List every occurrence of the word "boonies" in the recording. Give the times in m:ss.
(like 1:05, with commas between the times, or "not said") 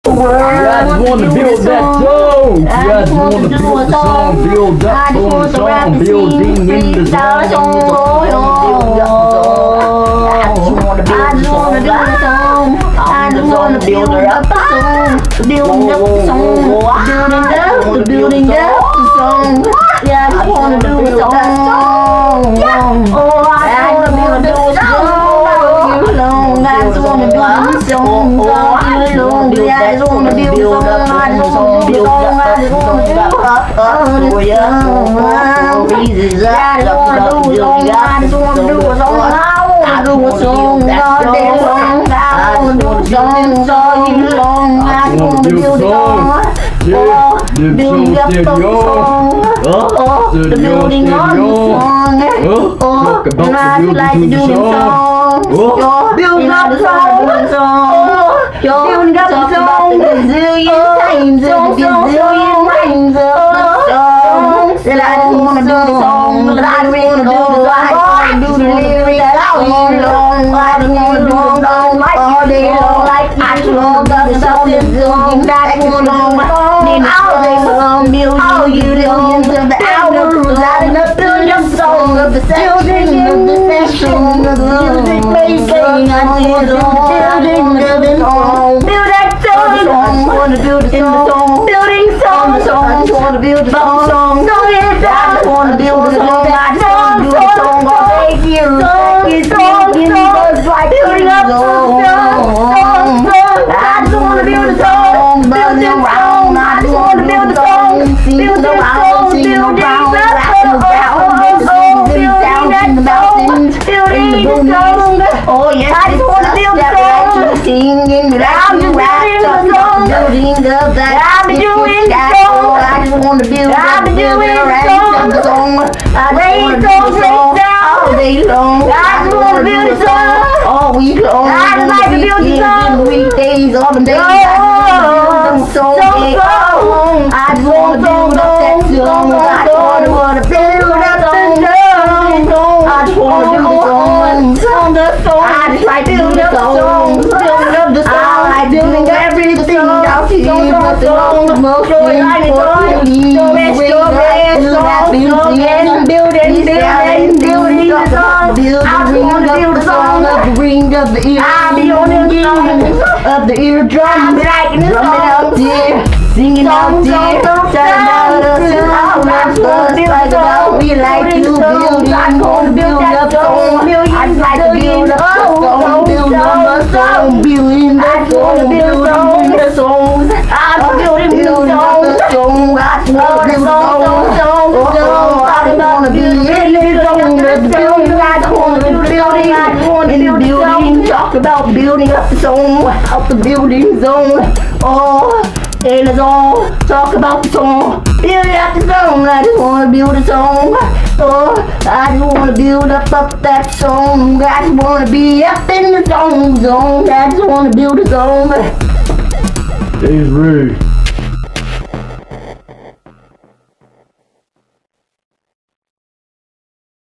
1:54.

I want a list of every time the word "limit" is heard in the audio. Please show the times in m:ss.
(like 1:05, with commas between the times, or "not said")
not said.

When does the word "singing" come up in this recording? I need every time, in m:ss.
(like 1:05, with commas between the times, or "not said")
1:57, 2:46.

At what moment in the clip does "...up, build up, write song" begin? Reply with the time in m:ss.
2:03.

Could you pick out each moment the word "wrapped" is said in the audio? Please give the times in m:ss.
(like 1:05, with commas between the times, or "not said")
1:58.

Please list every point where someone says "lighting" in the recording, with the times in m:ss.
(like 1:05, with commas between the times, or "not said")
1:20.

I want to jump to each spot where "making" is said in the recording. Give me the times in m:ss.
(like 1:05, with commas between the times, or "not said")
1:25.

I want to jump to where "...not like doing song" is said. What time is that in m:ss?
0:53.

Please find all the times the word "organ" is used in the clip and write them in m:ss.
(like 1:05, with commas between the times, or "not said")
2:23.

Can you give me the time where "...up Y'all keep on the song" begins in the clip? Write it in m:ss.
2:29.